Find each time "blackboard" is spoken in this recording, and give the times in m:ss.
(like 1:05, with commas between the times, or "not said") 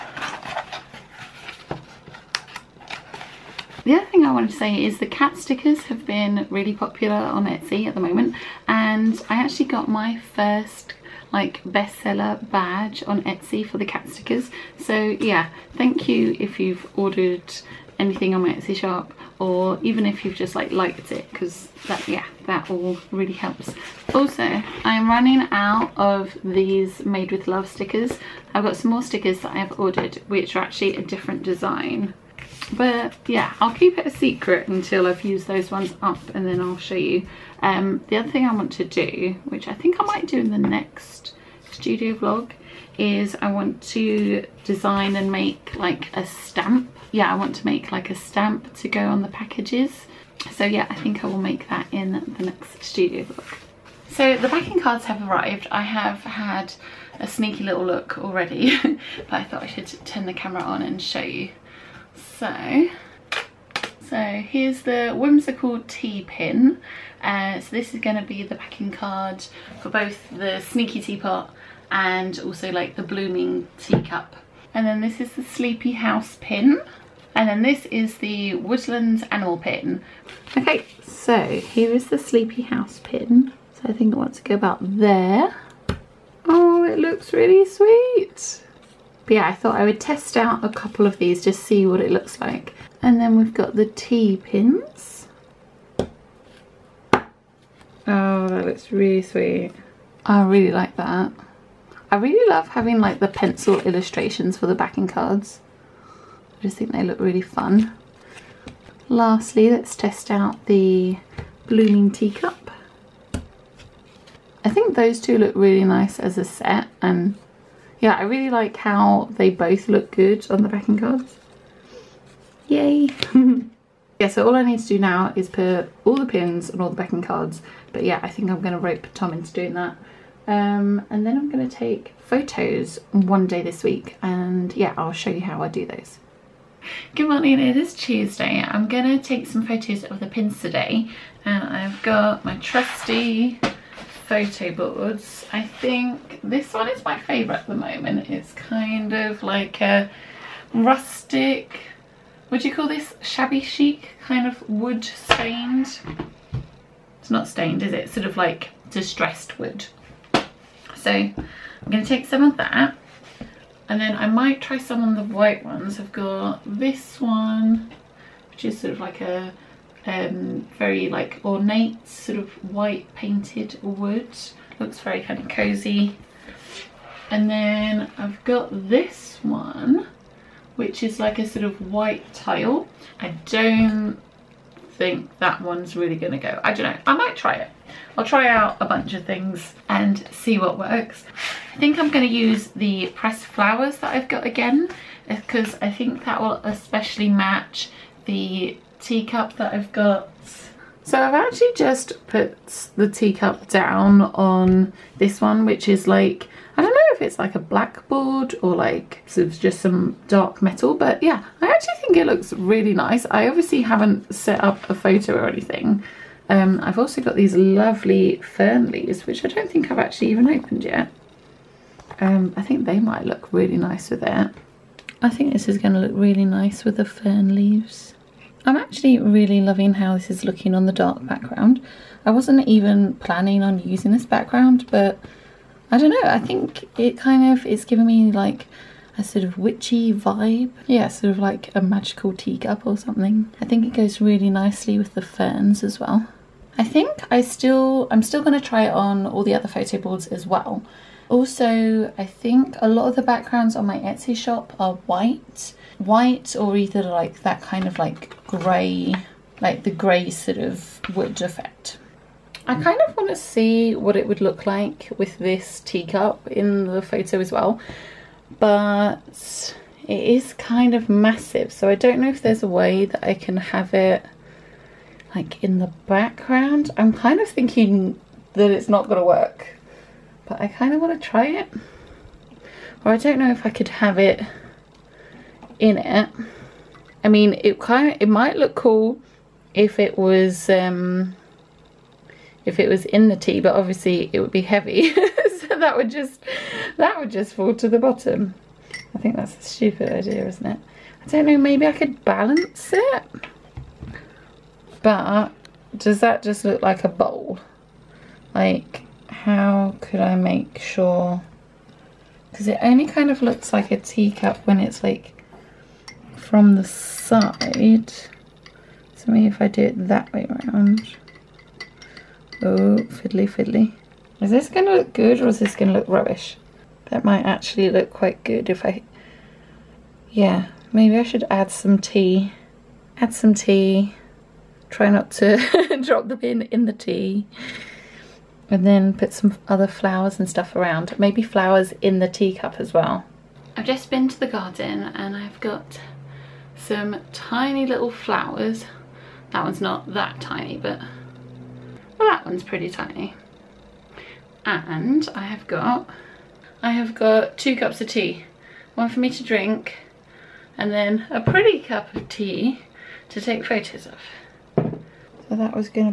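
3:27.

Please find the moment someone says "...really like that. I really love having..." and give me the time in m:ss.
1:40.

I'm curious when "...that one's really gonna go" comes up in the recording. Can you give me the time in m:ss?
3:05.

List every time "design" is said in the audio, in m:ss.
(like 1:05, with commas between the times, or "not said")
0:31, 0:44.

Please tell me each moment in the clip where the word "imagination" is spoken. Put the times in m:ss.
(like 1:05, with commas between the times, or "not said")
not said.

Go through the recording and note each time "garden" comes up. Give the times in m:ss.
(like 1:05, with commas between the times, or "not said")
5:44.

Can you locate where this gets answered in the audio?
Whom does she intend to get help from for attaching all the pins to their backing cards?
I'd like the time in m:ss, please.
2:09.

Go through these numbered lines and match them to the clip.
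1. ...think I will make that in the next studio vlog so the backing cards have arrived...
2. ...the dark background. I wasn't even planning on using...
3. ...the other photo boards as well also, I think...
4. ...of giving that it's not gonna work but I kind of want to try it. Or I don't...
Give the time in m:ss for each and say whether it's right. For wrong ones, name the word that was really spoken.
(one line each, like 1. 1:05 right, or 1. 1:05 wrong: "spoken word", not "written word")
1. 0:50 right
2. 3:50 right
3. 4:09 right
4. 4:37 wrong: "thinking", not "giving".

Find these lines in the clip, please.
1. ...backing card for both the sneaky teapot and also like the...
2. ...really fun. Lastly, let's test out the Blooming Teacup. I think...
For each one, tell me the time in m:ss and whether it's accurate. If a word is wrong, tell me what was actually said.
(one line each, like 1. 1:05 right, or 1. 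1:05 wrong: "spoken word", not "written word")
1. 1:08 right
2. 1:47 right.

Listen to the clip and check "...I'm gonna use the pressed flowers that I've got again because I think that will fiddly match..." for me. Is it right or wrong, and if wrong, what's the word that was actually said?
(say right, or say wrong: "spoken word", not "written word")
wrong: "especially", not "fiddly".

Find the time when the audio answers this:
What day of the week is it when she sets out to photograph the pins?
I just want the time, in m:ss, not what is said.
2:17.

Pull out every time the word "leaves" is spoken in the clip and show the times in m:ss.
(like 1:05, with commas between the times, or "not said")
3:38, 3:47.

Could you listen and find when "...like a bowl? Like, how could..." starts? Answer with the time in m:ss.
5:06.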